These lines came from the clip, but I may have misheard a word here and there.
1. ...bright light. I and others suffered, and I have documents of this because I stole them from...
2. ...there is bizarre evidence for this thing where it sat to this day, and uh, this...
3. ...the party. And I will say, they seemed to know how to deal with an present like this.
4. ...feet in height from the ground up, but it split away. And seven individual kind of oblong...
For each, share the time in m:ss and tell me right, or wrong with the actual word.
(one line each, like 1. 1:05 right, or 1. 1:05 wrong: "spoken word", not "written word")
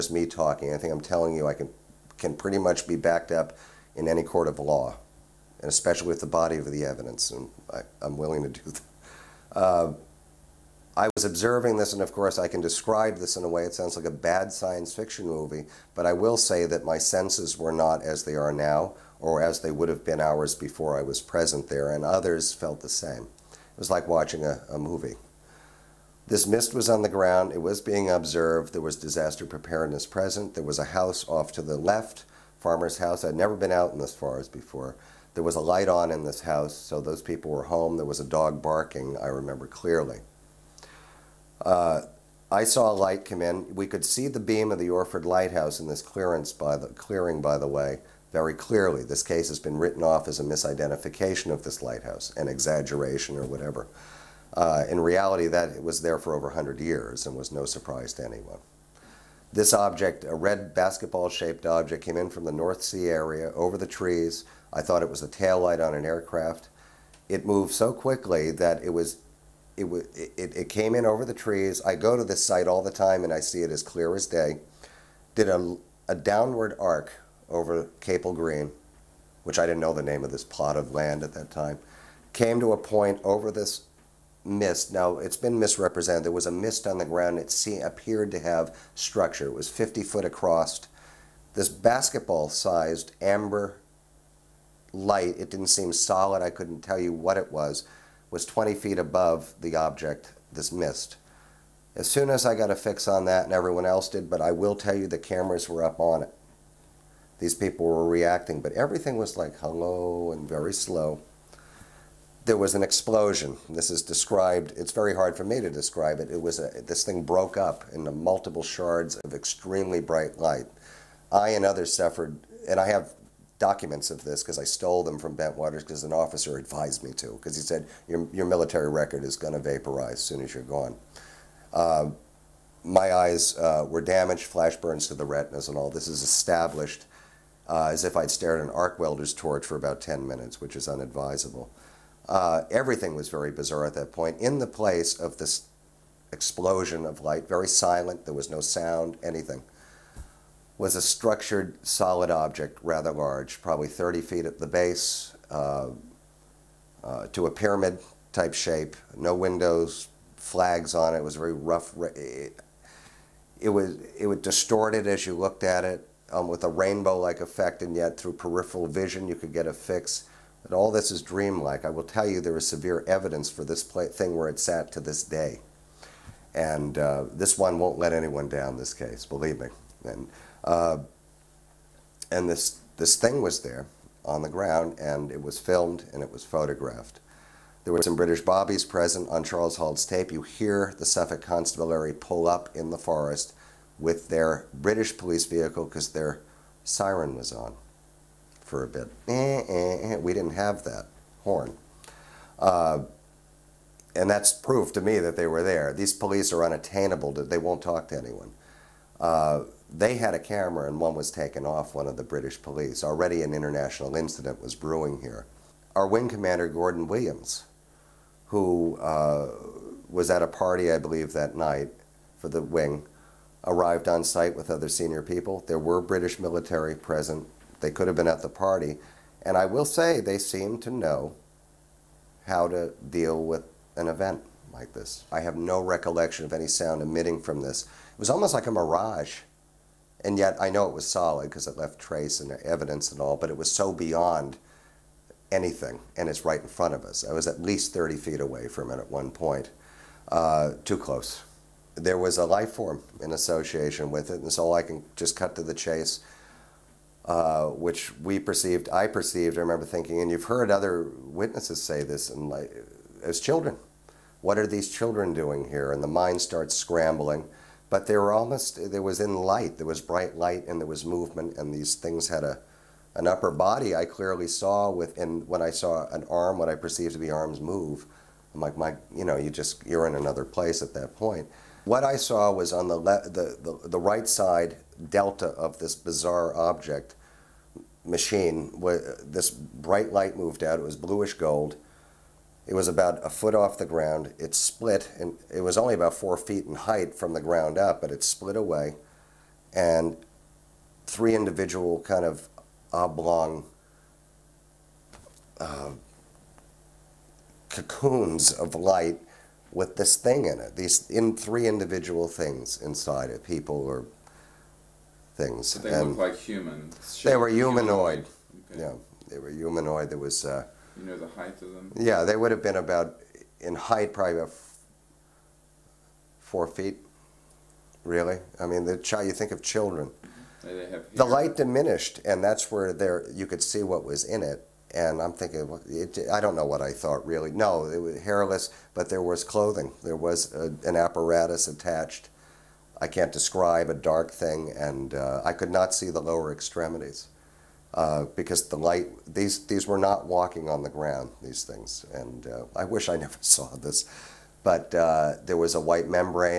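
1. 1:59 right
2. 2:52 wrong: "severe", not "bizarre"
3. 3:48 wrong: "event", not "present"
4. 4:56 wrong: "three", not "seven".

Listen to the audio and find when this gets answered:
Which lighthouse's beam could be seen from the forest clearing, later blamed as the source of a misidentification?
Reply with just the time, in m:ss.
0:44.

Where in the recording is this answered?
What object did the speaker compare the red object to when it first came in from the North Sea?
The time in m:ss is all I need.
1:00.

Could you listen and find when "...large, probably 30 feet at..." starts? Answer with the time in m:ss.
2:33.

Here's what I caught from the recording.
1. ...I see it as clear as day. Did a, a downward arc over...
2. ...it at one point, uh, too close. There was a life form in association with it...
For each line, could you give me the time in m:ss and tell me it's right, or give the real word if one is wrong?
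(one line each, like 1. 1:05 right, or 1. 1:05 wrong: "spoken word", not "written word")
1. 1:13 right
2. 4:08 right.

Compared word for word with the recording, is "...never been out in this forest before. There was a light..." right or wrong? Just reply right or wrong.
right.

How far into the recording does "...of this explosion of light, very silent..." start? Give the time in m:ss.
2:25.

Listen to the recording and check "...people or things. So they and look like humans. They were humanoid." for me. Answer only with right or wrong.
right.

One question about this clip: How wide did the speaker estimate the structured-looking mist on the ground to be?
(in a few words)
50 feet.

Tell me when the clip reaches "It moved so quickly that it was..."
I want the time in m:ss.
1:07.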